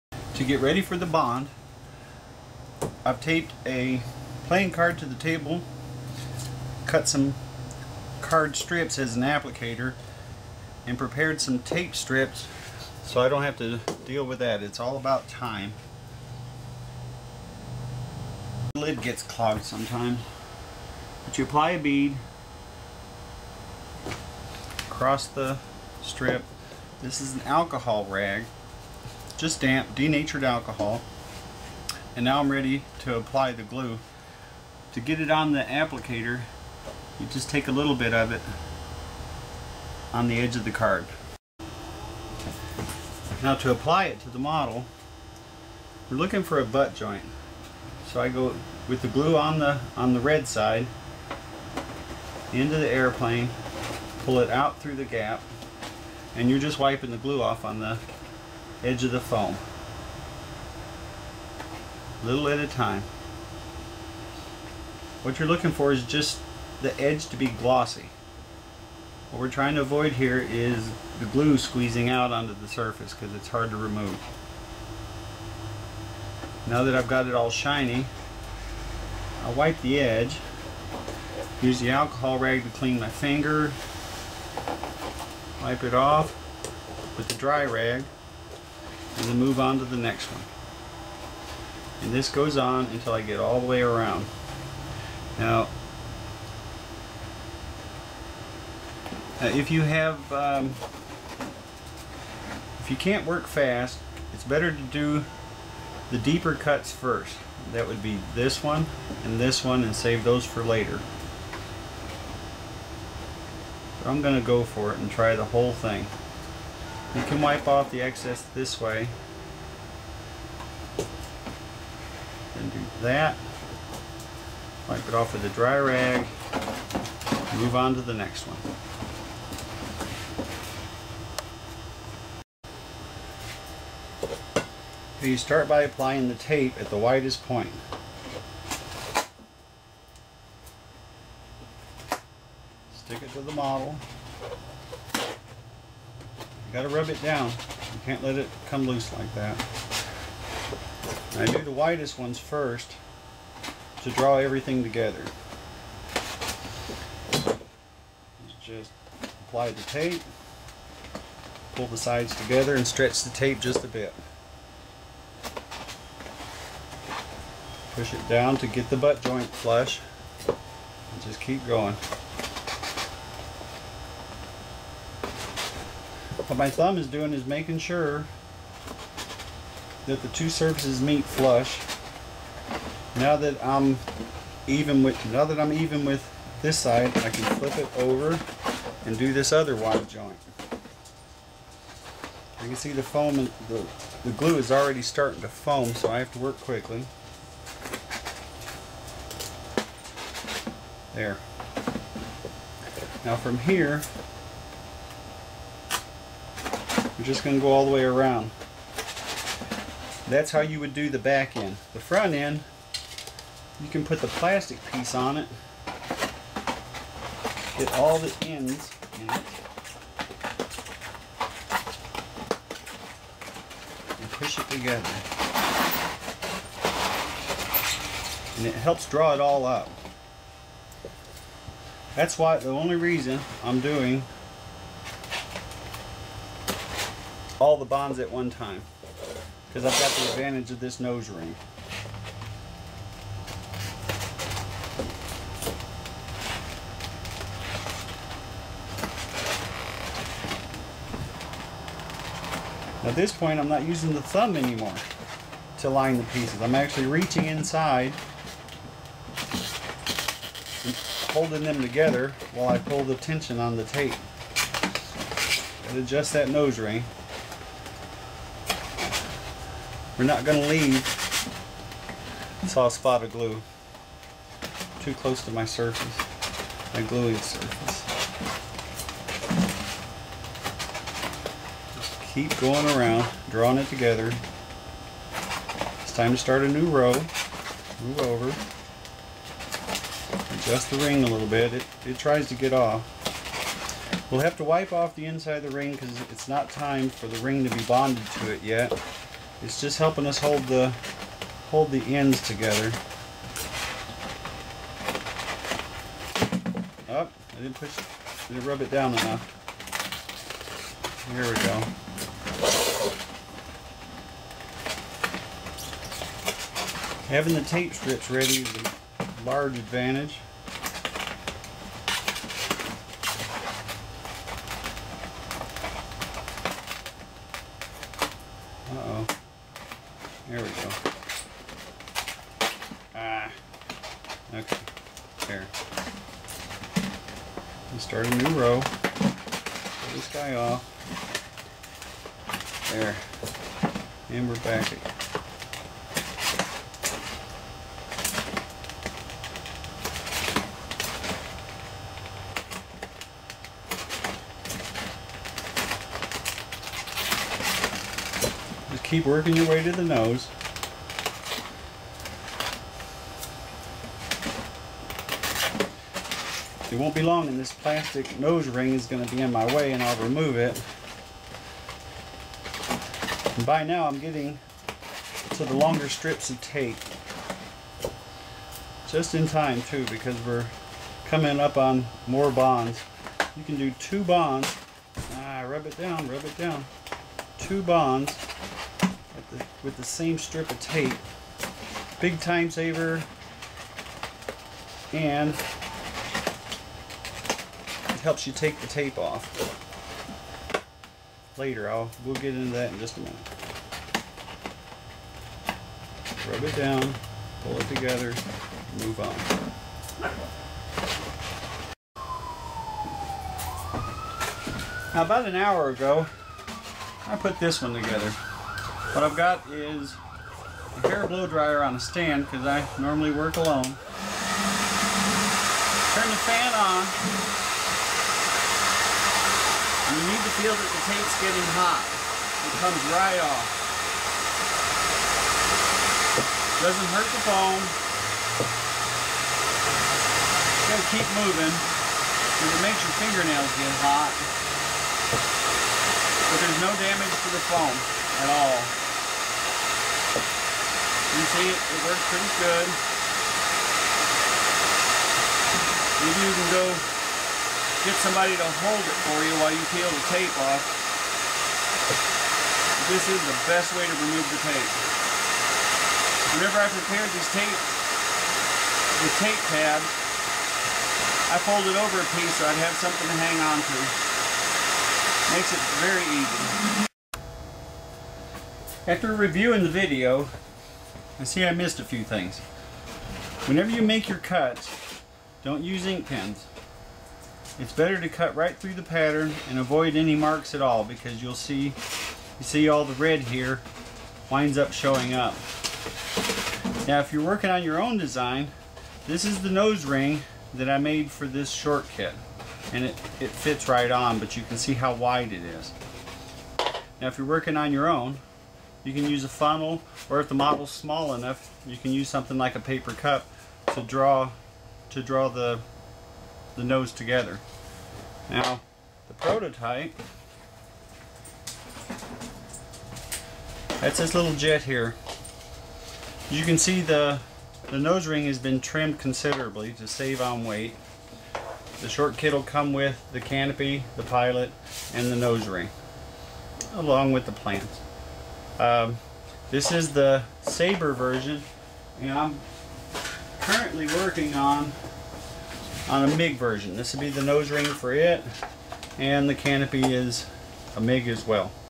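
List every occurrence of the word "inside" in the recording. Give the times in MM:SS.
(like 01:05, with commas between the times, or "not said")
04:17, 04:55.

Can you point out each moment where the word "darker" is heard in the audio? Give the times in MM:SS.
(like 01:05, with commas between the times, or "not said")
not said.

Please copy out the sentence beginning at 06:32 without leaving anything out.
Big time saver and it helps you take the tape off.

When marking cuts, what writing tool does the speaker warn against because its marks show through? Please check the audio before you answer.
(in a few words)
ink pens.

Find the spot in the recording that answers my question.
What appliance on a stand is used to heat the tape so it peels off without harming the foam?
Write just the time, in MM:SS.
07:01.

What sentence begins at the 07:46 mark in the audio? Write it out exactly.
Whenever I prepared these tape, the tape tab, I fold it over a piece so I'd have something to hang on to.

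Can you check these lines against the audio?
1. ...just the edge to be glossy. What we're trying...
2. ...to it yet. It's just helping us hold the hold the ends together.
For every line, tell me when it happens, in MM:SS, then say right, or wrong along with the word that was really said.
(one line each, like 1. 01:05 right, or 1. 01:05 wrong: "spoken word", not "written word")
1. 01:06 right
2. 04:58 right.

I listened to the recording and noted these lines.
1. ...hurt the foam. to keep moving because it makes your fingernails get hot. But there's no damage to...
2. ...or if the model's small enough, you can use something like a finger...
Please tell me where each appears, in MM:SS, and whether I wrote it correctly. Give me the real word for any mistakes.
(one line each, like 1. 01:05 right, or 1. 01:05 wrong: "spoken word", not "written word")
1. 07:17 right
2. 08:30 wrong: "paper", not "finger".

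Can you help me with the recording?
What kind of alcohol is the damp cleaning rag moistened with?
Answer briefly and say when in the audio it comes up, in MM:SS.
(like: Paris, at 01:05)
denatured alcohol, at 00:29.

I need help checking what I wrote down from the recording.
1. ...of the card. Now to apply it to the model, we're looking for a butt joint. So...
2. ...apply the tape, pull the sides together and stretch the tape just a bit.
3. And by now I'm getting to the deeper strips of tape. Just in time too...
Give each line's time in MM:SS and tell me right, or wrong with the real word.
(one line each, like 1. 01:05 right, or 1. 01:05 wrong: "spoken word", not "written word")
1. 00:40 right
2. 02:39 right
3. 06:13 wrong: "longer", not "deeper".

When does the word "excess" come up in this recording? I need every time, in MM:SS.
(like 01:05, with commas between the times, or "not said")
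01:58.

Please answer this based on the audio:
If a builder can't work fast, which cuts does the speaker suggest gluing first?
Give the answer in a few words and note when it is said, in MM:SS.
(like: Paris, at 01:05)
the deeper cuts, at 01:46.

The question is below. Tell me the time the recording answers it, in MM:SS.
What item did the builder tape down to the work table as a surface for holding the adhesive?
00:04.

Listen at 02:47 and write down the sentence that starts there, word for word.
Push it down to get the butt joint flush.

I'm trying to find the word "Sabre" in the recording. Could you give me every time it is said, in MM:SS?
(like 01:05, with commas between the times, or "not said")
09:00.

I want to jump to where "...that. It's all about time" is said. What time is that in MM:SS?
00:14.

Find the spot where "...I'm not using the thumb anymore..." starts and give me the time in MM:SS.
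04:13.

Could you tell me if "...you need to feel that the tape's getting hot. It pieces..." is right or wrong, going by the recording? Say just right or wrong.
wrong.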